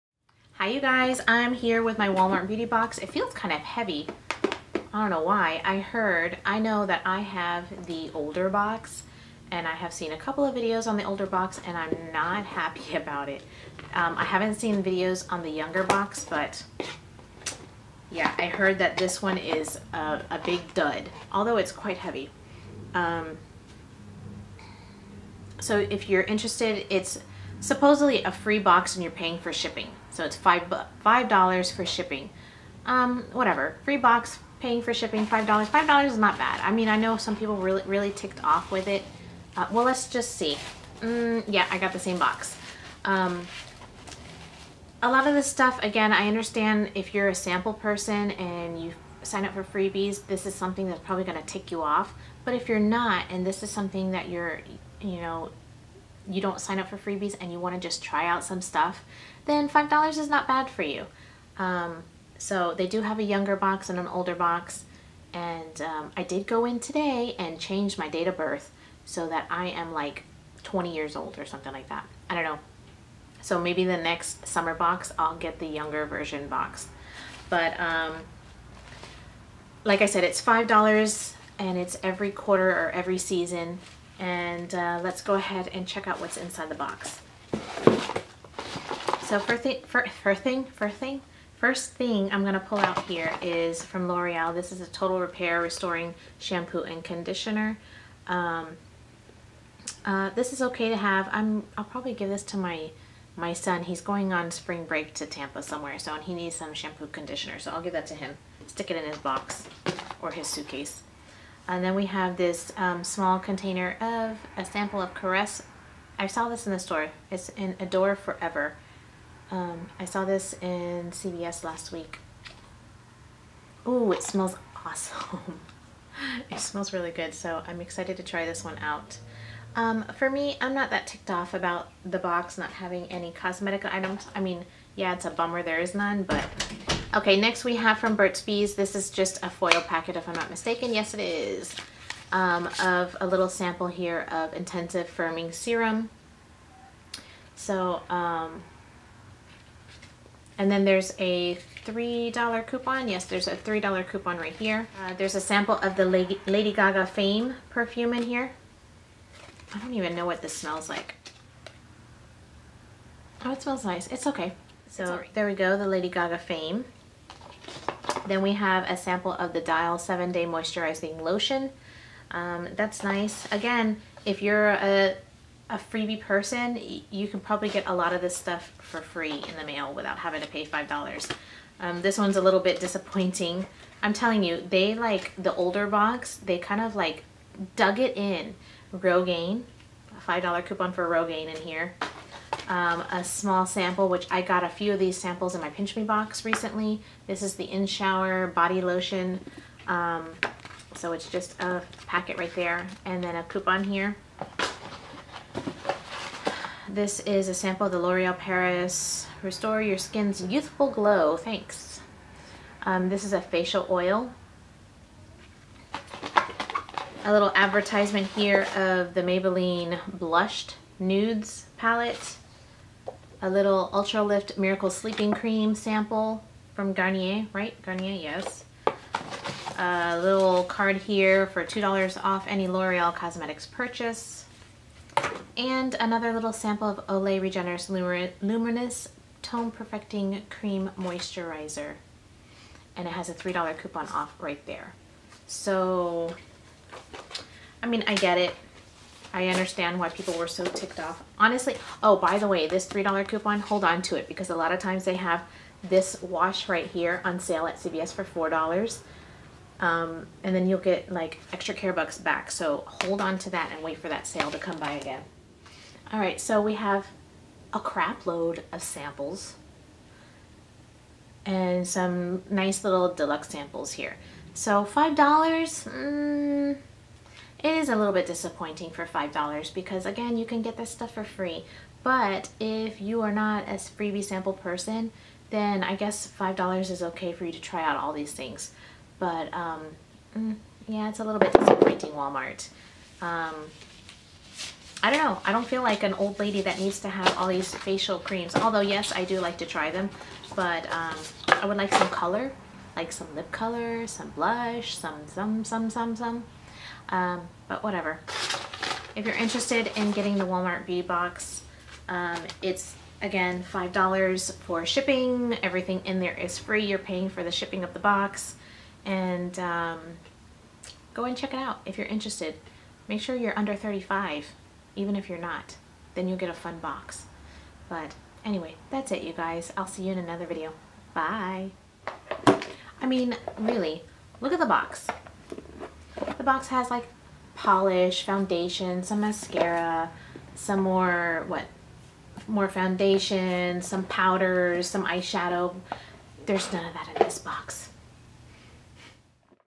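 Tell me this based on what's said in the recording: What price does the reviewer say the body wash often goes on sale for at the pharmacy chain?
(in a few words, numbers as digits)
$4.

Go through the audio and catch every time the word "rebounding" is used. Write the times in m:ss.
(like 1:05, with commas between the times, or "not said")
not said.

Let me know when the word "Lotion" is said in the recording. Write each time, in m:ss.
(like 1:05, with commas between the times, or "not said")
2:51, 3:18.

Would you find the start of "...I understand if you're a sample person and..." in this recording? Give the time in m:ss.
0:46.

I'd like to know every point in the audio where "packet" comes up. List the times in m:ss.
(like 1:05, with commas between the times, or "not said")
2:19, 3:22.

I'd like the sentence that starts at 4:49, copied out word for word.
But um, mm, yeah, it's a little bit disappointing, Walmart.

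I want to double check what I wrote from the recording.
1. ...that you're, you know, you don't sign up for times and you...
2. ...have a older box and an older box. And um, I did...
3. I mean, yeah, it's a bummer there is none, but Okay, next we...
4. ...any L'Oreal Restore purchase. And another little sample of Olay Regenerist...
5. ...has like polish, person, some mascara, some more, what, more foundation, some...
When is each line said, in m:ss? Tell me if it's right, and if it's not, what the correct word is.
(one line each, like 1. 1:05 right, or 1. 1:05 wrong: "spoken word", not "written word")
1. 0:54 wrong: "freebies", not "times"
2. 1:03 wrong: "younger", not "older"
3. 2:14 right
4. 3:52 wrong: "Cosmetics", not "Restore"
5. 5:36 wrong: "foundation", not "person".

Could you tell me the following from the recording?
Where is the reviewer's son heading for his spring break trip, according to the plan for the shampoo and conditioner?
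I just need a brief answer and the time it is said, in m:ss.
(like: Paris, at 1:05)
Tampa, at 1:45.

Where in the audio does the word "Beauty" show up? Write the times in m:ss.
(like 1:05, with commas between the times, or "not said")
0:02, 5:10.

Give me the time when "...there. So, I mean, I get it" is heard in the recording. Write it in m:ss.
4:04.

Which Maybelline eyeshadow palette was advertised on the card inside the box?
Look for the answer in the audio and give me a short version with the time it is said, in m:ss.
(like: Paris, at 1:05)
Blushed Nudes, at 3:40.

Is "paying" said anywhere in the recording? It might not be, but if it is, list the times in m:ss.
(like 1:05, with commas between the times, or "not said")
0:29, 0:34, 5:16.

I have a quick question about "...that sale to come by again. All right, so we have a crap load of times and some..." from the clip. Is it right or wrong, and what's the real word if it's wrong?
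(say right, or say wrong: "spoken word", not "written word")
wrong: "samples", not "times".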